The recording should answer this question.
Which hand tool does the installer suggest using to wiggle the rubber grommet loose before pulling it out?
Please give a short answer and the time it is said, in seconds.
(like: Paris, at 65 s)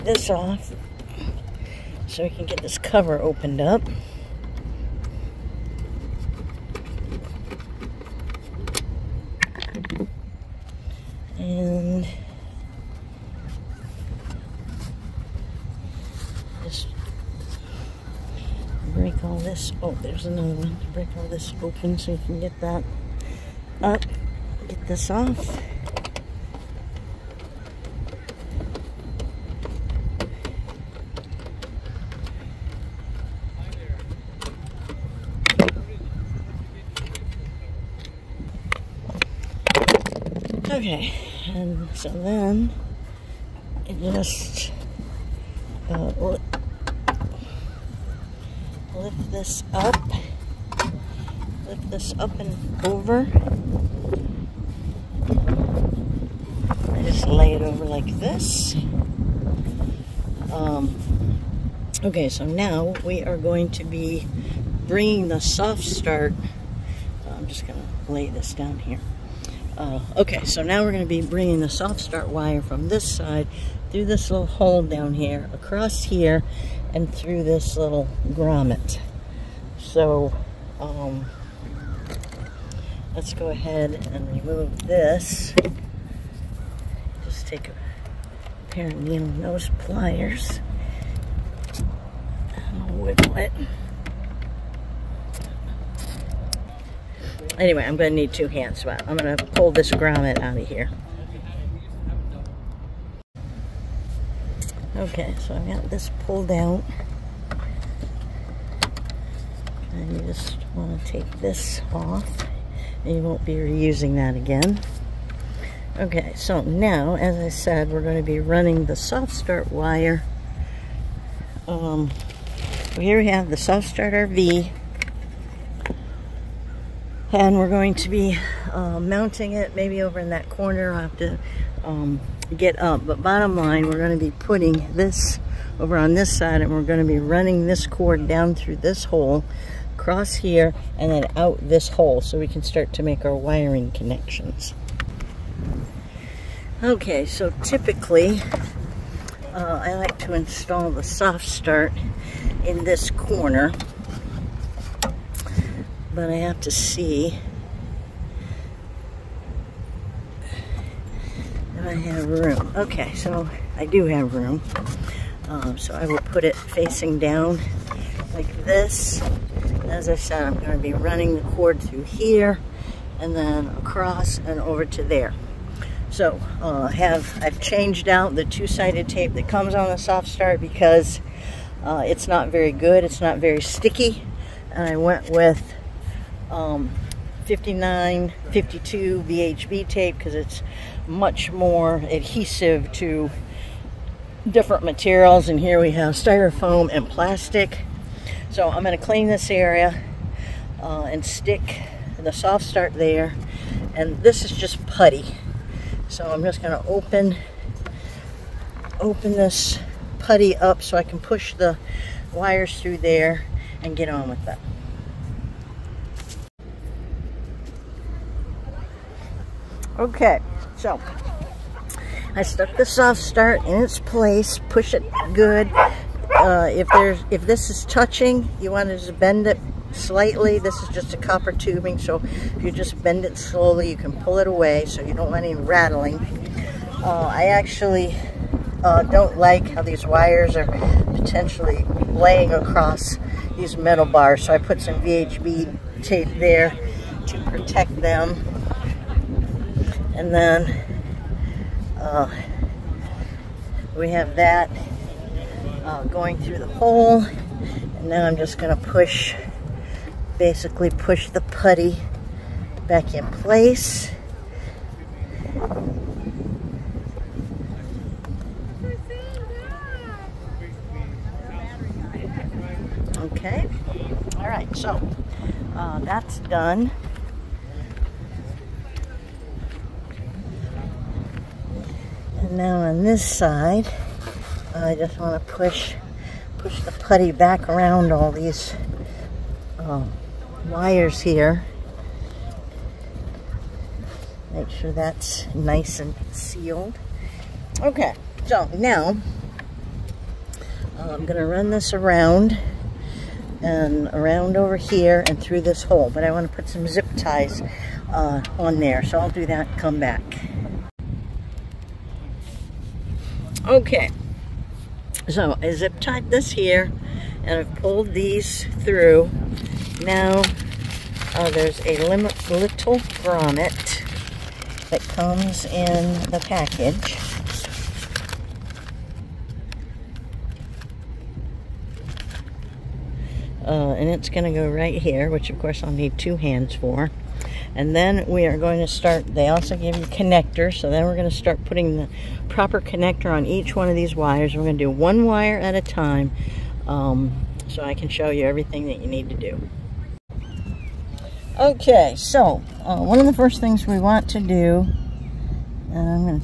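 Needle nose pliers, at 89 s.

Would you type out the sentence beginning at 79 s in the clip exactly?
So, um, let's go ahead and remove this.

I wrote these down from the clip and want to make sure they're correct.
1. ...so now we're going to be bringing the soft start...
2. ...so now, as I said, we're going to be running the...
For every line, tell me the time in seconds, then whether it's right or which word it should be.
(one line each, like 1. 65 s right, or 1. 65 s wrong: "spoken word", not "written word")
1. 70 s right
2. 116 s right.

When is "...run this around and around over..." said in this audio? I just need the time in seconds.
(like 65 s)
301 s.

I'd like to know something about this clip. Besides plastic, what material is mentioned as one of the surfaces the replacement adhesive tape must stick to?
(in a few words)
Styrofoam.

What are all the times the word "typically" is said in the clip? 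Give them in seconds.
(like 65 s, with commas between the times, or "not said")
147 s.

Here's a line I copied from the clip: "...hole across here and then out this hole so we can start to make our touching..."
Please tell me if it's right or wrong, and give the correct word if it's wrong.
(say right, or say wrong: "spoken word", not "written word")
wrong: "wiring", not "touching".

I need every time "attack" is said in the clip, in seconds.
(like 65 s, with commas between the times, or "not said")
not said.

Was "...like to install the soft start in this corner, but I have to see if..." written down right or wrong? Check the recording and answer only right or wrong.
right.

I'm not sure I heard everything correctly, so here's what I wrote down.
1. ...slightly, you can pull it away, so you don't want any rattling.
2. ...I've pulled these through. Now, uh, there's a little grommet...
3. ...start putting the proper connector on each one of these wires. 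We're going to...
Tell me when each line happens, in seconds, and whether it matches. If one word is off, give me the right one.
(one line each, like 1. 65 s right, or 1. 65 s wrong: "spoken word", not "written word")
1. 233 s wrong: "slowly", not "slightly"
2. 317 s right
3. 341 s right.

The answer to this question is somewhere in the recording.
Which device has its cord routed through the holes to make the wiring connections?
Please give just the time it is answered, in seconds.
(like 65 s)
123 s.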